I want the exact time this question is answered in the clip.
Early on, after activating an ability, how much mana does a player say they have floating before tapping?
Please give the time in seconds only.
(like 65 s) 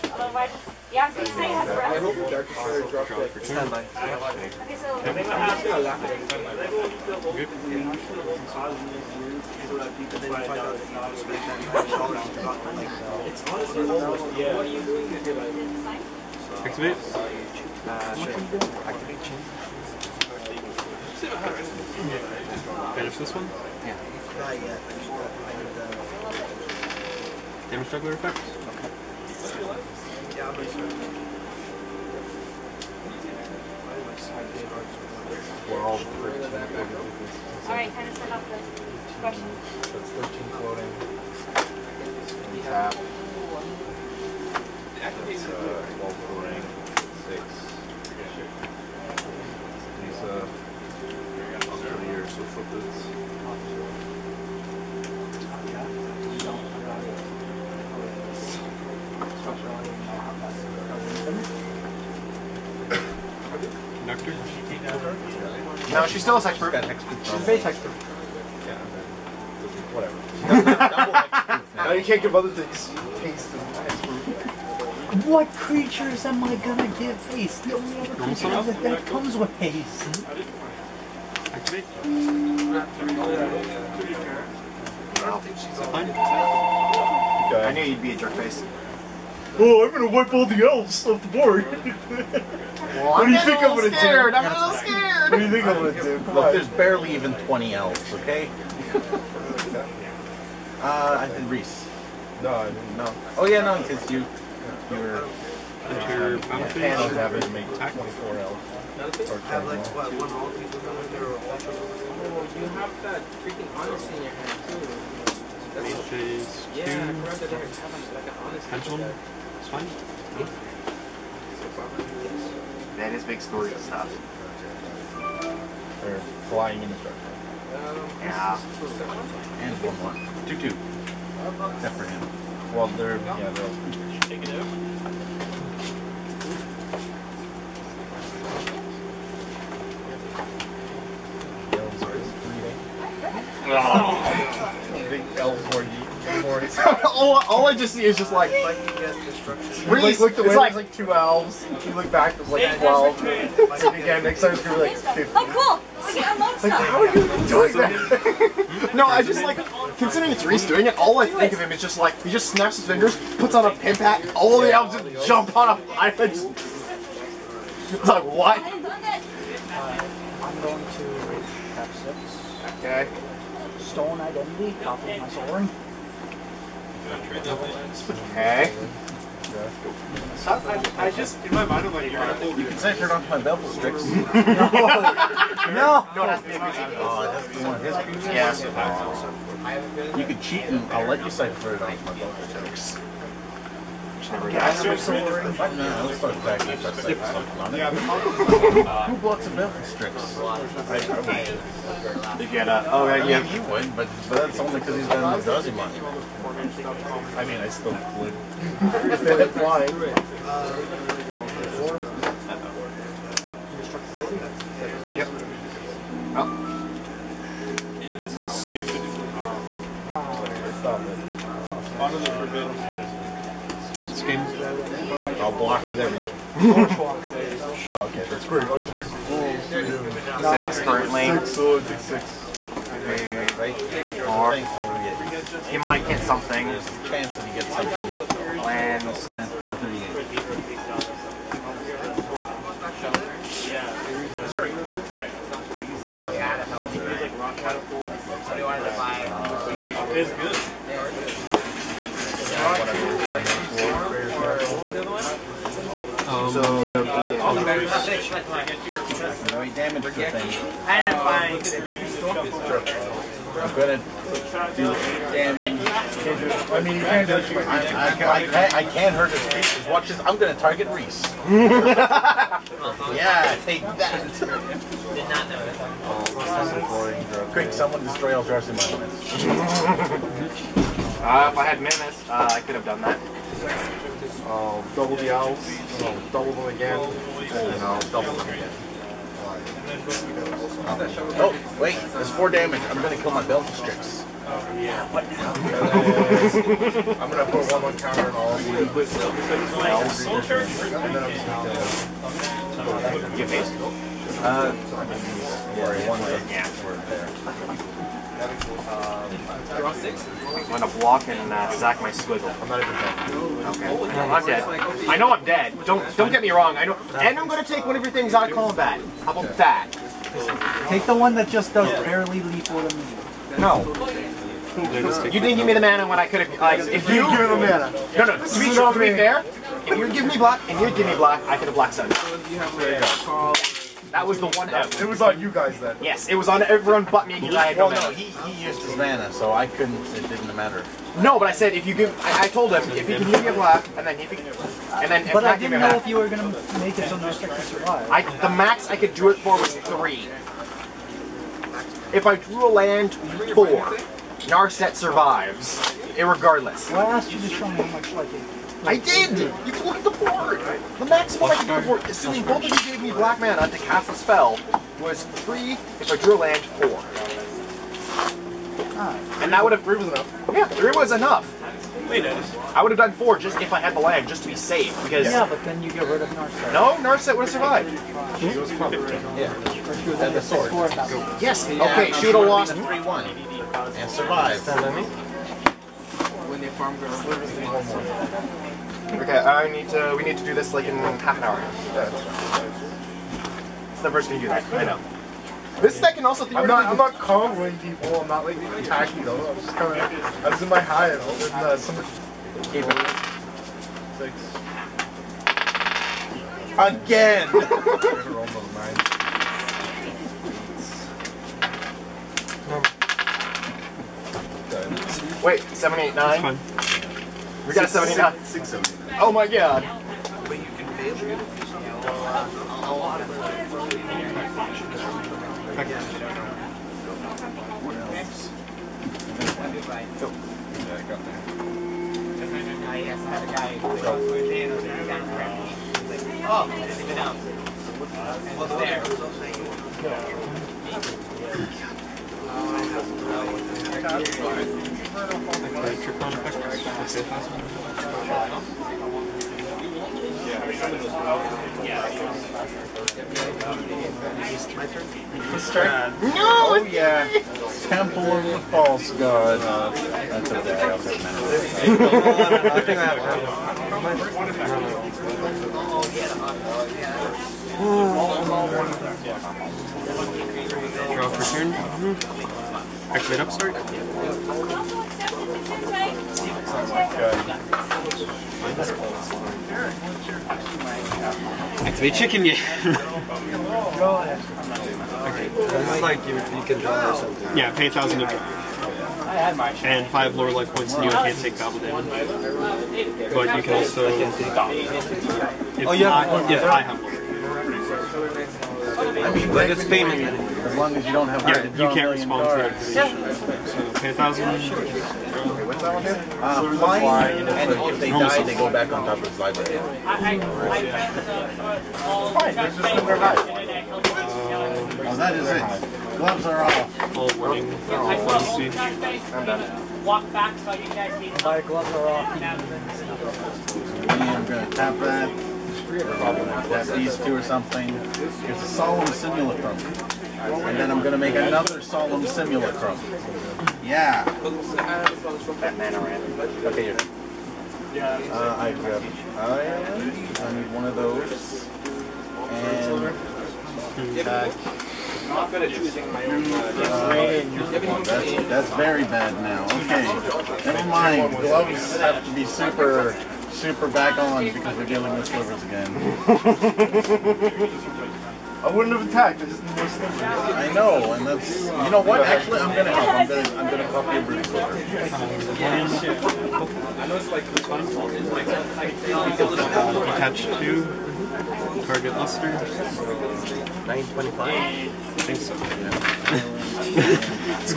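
40 s.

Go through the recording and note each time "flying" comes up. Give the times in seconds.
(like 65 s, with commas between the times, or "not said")
126 s, 506 s.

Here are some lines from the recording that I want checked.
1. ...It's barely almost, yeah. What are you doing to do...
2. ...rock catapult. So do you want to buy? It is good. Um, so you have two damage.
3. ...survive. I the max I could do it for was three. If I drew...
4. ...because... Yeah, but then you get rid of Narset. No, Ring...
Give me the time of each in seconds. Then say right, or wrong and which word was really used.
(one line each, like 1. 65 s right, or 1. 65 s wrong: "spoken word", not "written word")
1. 13 s wrong: "honestly", not "barely"
2. 247 s wrong: "eight", not "two"
3. 347 s right
4. 375 s wrong: "Narset", not "Ring".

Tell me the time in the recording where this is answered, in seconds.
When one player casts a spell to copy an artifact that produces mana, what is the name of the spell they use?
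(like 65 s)
173 s.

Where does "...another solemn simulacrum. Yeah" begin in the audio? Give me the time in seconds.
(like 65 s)
531 s.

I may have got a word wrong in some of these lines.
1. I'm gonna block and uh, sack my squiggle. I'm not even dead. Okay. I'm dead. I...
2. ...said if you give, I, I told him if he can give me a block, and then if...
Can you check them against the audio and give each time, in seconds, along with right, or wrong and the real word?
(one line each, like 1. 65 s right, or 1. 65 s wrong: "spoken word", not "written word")
1. 308 s right
2. 341 s wrong: "black", not "block".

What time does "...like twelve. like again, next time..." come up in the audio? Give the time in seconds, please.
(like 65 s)
152 s.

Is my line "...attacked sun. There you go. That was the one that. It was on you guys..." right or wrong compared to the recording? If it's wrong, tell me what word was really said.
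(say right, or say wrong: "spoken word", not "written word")
wrong: "blocked", not "attacked".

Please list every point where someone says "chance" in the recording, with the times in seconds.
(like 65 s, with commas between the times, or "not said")
237 s.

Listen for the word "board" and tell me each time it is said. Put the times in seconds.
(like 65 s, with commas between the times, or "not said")
91 s, 360 s.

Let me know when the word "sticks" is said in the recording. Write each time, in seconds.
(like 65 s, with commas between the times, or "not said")
183 s, 347 s.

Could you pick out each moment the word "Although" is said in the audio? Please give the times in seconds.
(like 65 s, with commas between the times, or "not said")
0 s.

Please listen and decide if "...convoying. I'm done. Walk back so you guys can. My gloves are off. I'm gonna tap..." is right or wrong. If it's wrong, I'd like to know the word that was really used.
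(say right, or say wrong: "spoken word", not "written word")
wrong: "warning", not "convoying".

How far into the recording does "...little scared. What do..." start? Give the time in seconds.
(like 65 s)
94 s.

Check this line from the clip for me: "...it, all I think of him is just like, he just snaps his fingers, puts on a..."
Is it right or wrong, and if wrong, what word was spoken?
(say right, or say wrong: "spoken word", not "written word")
right.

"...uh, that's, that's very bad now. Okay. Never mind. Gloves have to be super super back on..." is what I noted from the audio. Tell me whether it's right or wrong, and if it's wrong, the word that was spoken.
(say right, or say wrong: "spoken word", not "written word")
right.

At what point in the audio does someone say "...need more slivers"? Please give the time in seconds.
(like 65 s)
559 s.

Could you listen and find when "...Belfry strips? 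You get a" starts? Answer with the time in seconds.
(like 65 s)
199 s.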